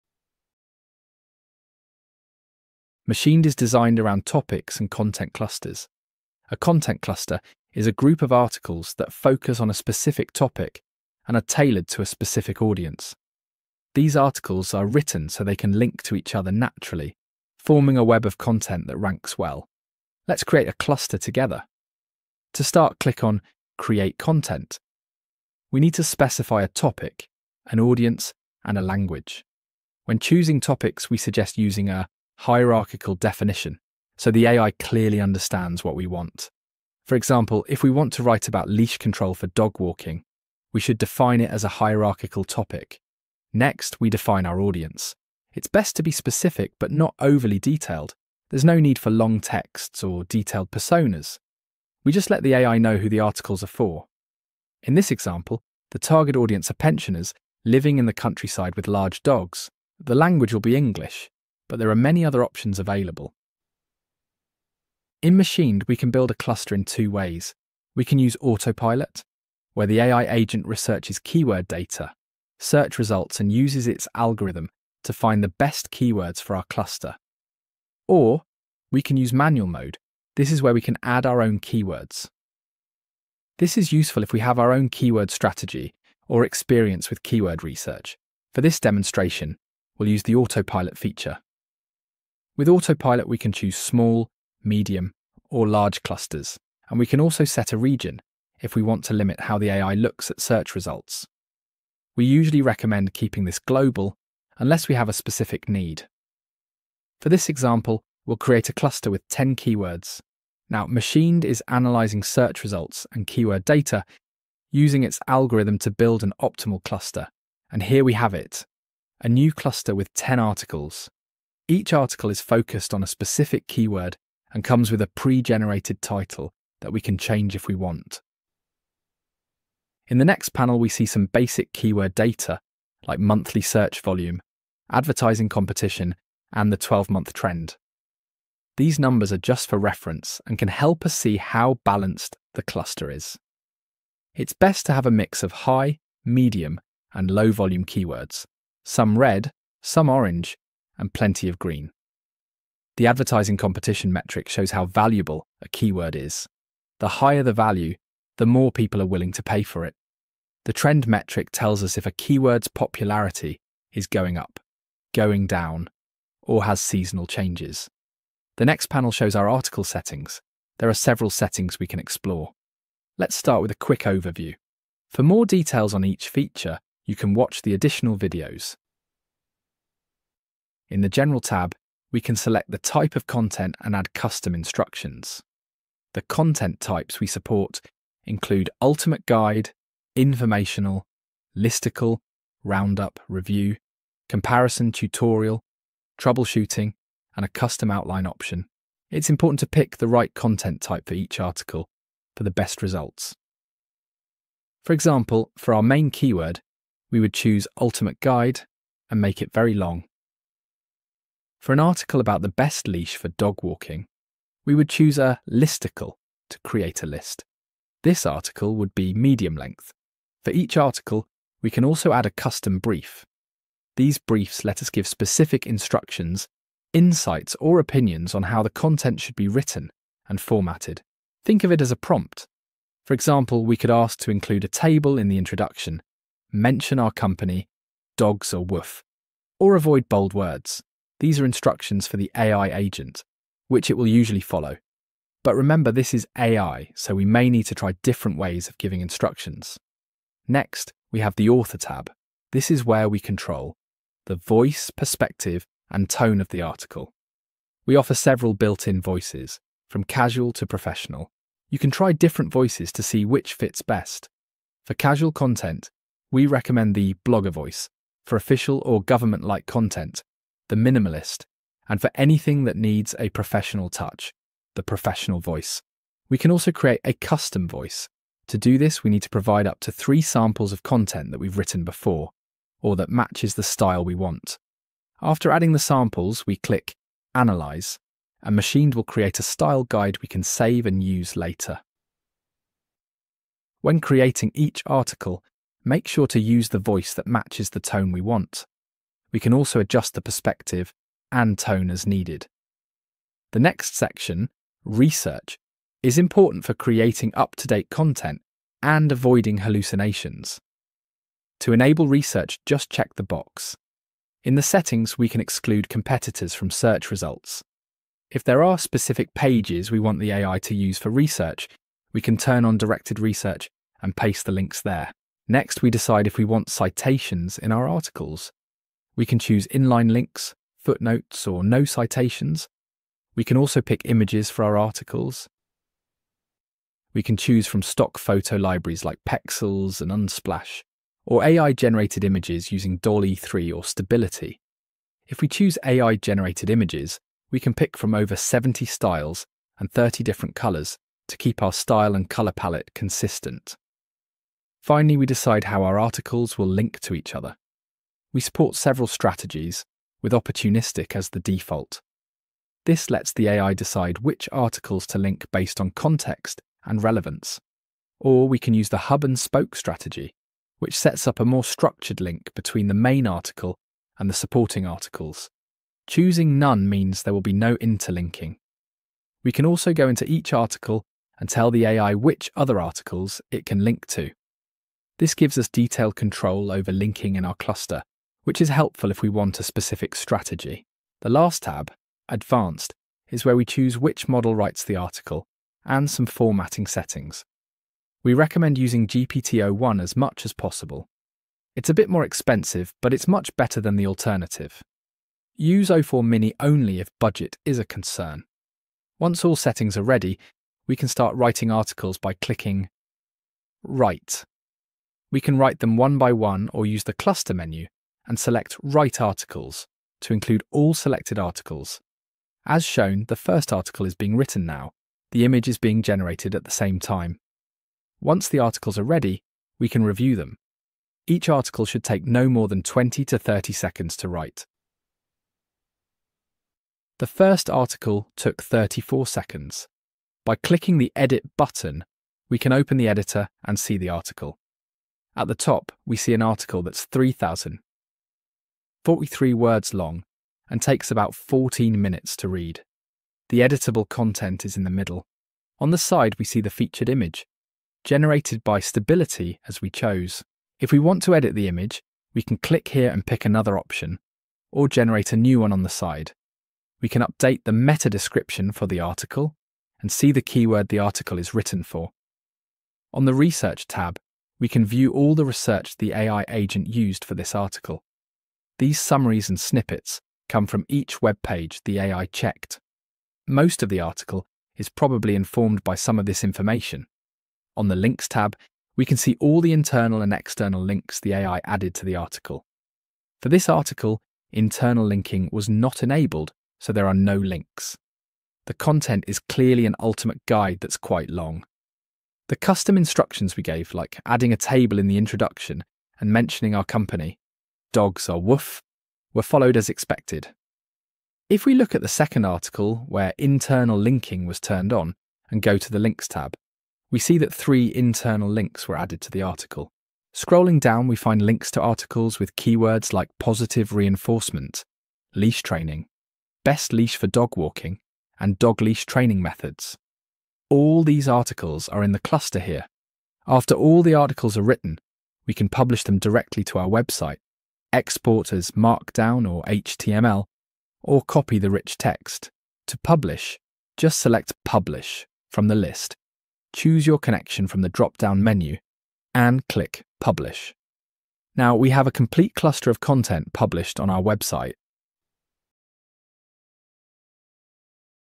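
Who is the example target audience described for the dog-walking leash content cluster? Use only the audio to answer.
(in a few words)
Pensioners living in the countryside.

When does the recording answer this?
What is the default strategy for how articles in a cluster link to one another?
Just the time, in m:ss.
6:00.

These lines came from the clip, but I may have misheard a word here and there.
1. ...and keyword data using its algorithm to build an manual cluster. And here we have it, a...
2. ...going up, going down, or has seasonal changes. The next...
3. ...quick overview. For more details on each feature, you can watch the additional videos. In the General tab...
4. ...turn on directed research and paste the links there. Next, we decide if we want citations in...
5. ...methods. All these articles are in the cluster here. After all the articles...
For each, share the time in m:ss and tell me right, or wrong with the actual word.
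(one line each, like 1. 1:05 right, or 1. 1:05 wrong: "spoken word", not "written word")
1. 1:53 wrong: "optimal", not "manual"
2. 2:44 right
3. 2:53 right
4. 5:22 right
5. 8:49 right.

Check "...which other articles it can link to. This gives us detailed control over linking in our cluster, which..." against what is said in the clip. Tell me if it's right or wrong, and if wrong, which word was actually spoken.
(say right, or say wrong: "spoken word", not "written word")
right.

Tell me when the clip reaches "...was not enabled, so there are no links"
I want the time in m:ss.
8:15.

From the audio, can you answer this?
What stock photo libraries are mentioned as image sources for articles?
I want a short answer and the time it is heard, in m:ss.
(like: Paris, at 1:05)
Pexels, at 5:39.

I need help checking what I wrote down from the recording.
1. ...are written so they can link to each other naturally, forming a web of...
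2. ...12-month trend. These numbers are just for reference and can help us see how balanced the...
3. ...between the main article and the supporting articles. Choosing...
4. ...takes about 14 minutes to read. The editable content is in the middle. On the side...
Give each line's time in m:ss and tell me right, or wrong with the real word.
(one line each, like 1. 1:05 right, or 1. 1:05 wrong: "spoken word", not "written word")
1. 0:14 right
2. 2:16 right
3. 6:12 right
4. 7:30 right.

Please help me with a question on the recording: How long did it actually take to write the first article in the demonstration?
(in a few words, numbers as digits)
34 seconds.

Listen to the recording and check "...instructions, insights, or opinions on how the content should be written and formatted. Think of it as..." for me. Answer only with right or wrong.
right.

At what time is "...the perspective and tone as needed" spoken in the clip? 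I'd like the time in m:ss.
5:00.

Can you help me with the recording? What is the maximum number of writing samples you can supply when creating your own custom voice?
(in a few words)
3.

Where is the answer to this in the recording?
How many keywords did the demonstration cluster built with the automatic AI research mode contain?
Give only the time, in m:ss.
1:49.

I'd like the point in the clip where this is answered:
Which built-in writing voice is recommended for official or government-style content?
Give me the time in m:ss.
4:30.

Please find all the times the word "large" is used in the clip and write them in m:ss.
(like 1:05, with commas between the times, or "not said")
0:58, 1:35.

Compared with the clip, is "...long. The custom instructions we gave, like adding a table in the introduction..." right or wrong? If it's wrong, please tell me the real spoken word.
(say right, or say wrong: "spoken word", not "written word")
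right.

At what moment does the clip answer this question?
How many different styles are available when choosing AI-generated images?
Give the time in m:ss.
5:48.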